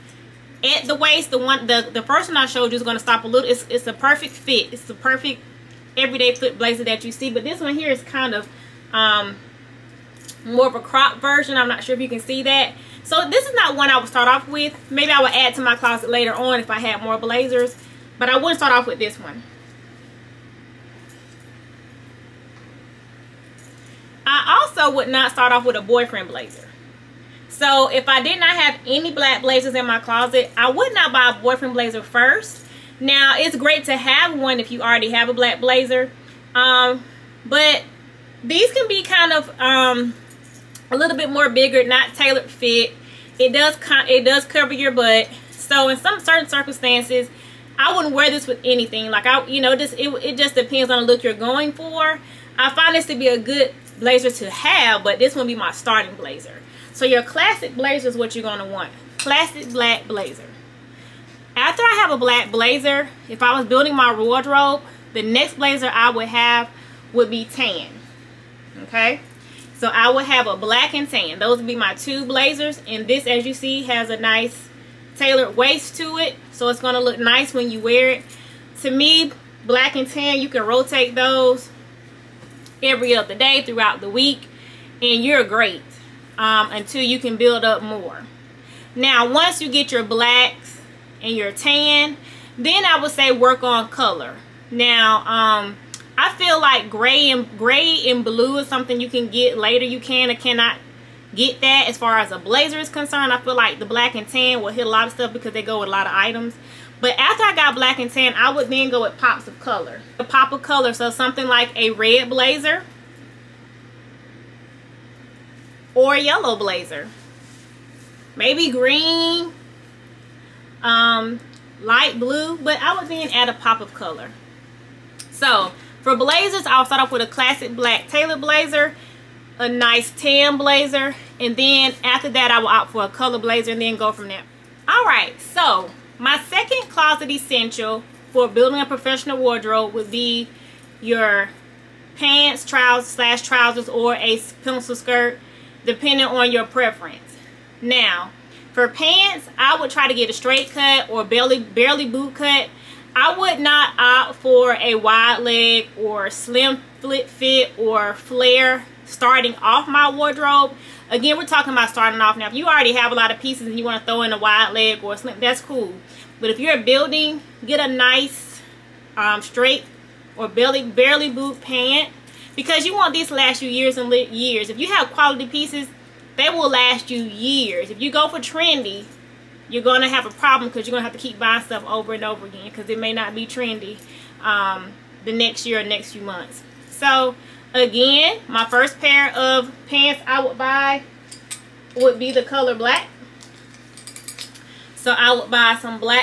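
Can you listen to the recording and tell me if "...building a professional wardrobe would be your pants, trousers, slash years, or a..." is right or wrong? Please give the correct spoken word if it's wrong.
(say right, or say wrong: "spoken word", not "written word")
wrong: "trousers", not "years".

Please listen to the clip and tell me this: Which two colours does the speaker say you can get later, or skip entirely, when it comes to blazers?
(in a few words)
Gray and blue.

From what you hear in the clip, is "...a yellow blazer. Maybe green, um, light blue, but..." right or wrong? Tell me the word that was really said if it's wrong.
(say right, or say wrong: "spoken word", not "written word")
right.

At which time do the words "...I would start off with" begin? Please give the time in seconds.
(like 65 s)
13 s.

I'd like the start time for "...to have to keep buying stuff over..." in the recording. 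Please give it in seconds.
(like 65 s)
181 s.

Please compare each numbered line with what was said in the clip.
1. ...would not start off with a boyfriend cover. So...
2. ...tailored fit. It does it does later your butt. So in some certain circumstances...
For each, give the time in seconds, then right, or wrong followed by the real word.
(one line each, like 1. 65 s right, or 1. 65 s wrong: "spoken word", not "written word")
1. 24 s wrong: "blazer", not "cover"
2. 42 s wrong: "cover", not "later".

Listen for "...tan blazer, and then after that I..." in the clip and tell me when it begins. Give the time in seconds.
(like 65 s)
130 s.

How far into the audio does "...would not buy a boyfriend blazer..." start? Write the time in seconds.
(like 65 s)
30 s.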